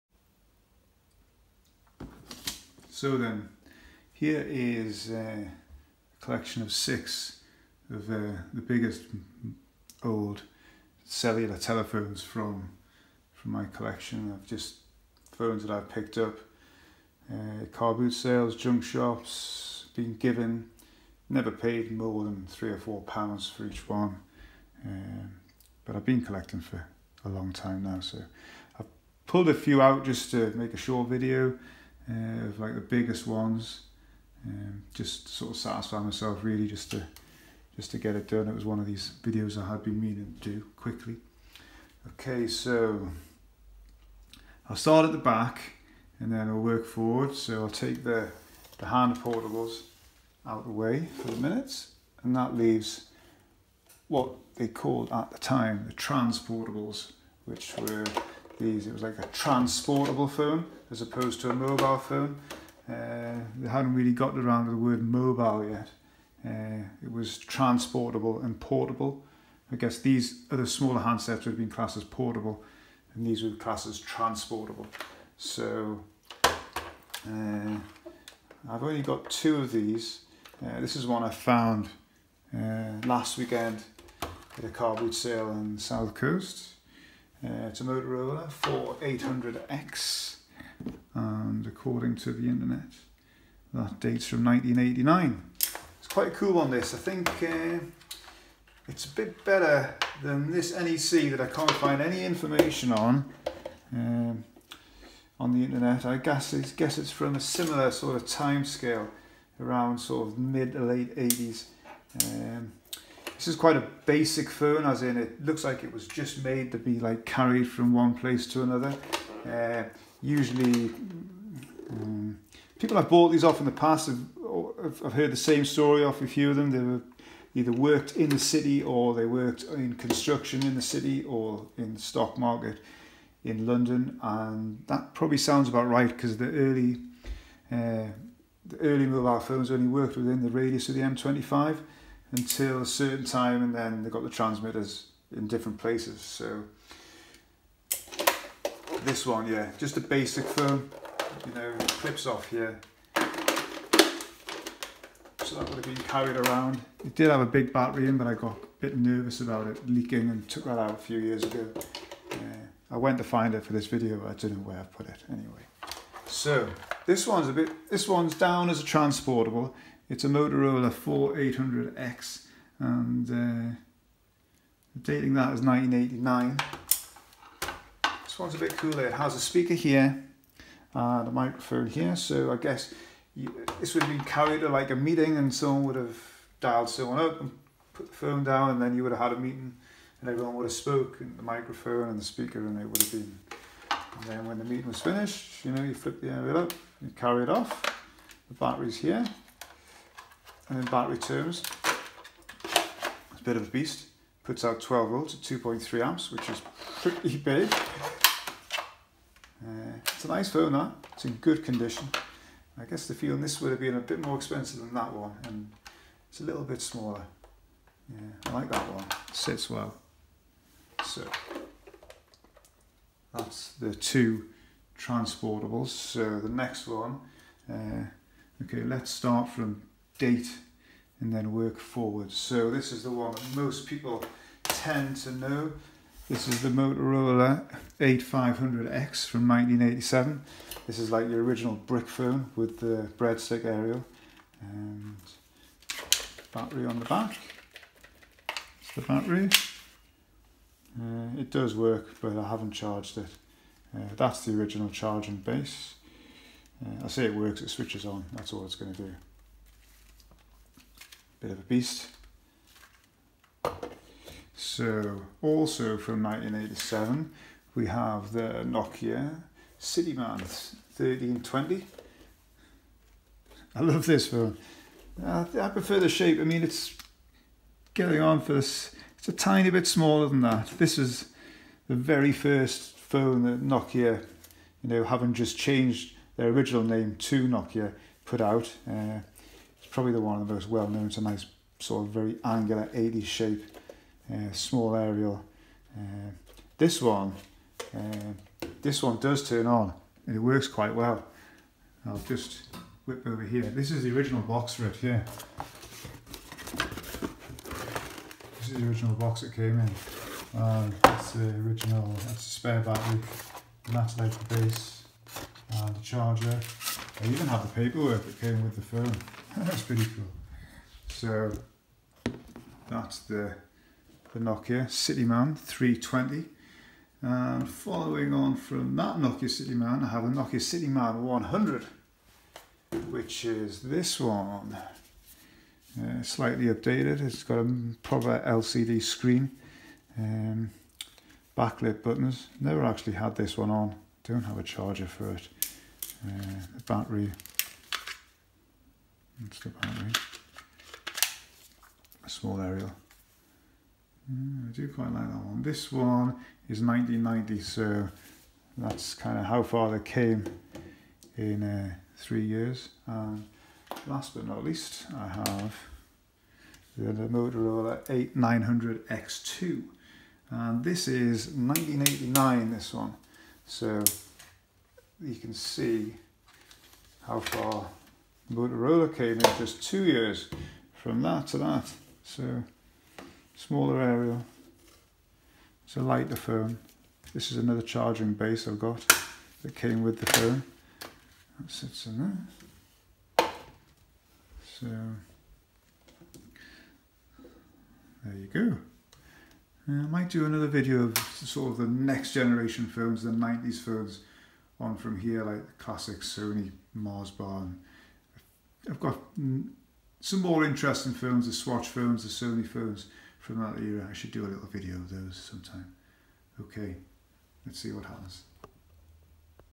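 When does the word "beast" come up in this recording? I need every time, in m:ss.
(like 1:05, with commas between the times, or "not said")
3:23, 4:21.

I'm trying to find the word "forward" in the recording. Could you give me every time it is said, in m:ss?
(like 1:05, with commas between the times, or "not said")
0:46, 3:51.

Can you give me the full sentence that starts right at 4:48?
Uh, it's probably the one of the most well known.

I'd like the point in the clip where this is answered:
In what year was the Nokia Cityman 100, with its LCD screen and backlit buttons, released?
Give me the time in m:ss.
5:56.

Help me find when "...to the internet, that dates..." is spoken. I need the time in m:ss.
1:32.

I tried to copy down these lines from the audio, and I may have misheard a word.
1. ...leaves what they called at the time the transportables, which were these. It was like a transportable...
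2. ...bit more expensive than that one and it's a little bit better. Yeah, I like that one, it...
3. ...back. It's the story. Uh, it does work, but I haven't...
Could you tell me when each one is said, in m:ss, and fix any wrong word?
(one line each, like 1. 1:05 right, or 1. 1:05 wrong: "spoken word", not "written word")
1. 0:52 right
2. 3:33 wrong: "smaller", not "better"
3. 4:07 wrong: "battery", not "story".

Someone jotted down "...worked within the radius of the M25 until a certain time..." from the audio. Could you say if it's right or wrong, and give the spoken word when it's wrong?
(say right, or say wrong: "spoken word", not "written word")
right.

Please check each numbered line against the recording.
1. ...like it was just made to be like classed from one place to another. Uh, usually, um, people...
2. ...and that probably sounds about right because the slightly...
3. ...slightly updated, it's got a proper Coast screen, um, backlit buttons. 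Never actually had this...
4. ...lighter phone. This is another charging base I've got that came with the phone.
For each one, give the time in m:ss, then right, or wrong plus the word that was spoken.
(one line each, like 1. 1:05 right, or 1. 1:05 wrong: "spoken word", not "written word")
1. 1:55 wrong: "carried", not "classed"
2. 2:14 wrong: "early", not "slightly"
3. 5:36 wrong: "LCD", not "Coast"
4. 6:26 right.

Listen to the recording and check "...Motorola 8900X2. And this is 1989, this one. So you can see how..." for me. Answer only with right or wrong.
right.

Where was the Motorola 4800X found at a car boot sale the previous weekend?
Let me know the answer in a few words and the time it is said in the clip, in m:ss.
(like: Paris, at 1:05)
South Coast, at 1:25.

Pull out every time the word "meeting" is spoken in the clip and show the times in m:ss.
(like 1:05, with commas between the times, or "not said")
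3:04, 3:09, 3:14.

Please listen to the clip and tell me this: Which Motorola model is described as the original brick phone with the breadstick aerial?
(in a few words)
Motorola 8500X.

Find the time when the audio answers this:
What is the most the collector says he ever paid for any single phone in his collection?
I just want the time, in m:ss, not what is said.
0:22.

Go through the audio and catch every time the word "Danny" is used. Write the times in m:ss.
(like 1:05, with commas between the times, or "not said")
not said.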